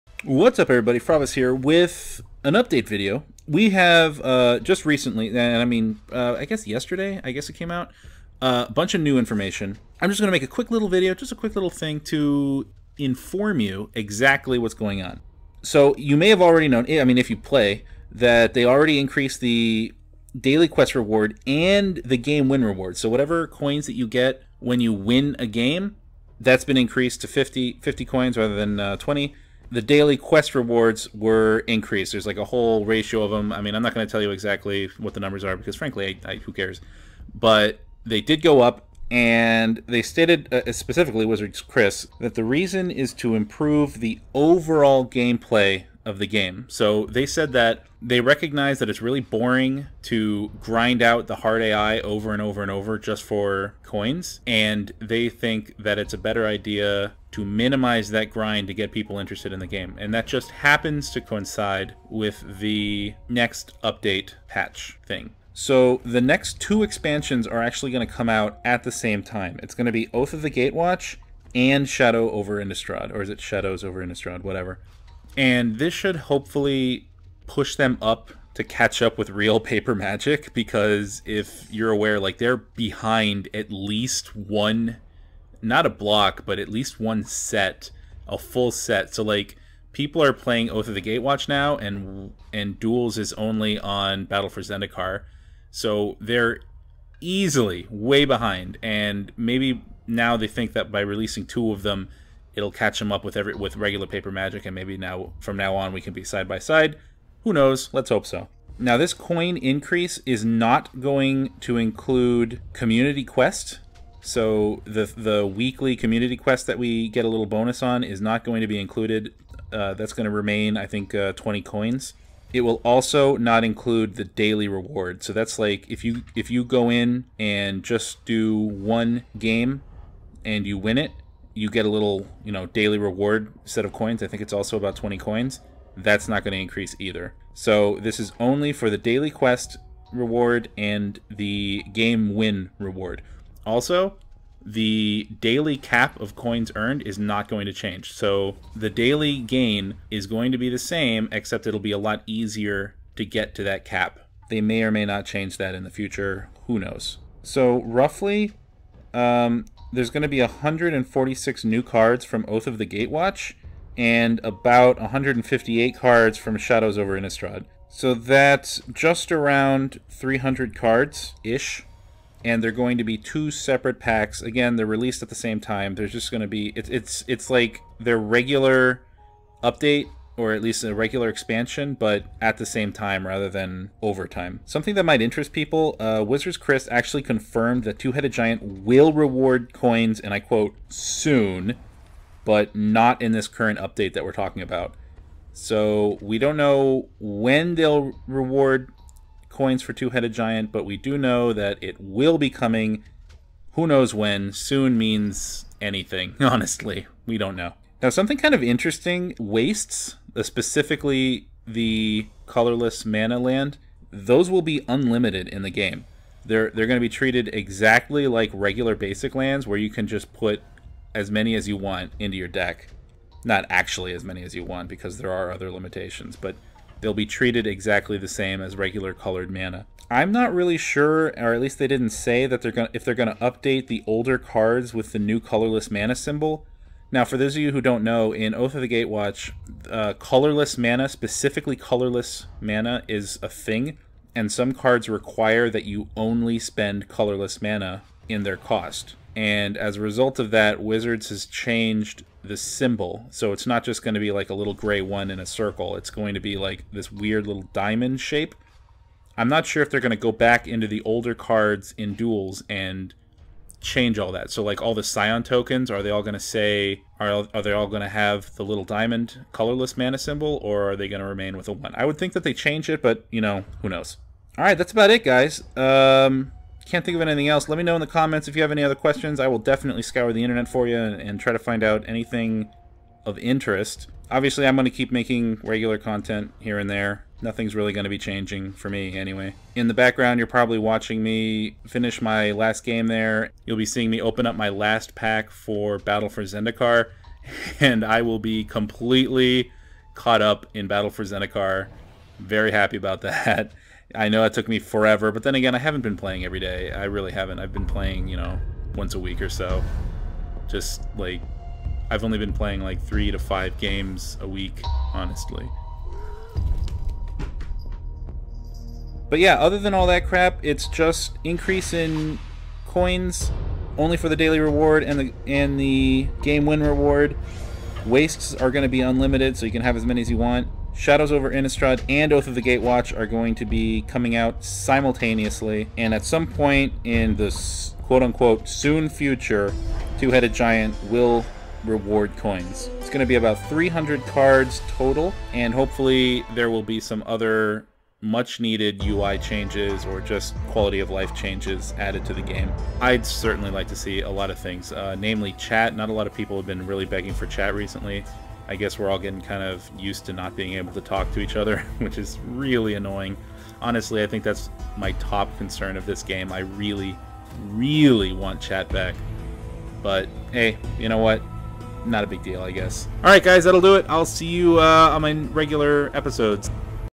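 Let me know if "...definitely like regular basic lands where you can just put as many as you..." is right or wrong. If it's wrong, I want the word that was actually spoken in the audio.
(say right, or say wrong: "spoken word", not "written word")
wrong: "exactly", not "definitely".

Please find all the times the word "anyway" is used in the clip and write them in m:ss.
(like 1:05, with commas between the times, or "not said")
4:49.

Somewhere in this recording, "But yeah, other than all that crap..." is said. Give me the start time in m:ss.
5:19.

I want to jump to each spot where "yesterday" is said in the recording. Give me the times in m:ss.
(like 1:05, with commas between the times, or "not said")
0:06.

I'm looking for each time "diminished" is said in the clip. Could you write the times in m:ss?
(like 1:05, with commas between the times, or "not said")
not said.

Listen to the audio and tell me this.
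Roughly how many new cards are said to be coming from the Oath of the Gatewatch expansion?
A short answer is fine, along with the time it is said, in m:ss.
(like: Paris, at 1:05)
146, at 2:40.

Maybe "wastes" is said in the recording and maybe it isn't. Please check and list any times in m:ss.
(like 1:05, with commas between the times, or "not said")
3:29, 5:28.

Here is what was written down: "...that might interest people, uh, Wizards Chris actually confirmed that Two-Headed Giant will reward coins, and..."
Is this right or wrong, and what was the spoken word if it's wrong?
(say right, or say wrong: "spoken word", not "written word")
right.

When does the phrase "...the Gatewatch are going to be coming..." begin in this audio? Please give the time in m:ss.
5:32.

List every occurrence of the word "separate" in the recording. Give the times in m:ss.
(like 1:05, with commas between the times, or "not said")
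2:53.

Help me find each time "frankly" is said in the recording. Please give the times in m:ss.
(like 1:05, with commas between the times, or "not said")
0:35.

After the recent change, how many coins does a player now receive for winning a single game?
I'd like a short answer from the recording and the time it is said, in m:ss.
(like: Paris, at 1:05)
50, at 0:27.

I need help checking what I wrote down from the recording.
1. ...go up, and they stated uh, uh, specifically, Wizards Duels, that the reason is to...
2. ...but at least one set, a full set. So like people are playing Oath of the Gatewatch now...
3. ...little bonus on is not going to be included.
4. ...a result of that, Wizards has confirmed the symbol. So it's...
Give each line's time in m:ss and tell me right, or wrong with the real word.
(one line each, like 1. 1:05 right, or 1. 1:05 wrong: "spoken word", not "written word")
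1. 0:38 wrong: "Chris", not "Duels"
2. 1:26 right
3. 1:57 right
4. 4:09 wrong: "changed", not "confirmed".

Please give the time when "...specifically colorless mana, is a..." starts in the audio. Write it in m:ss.
4:01.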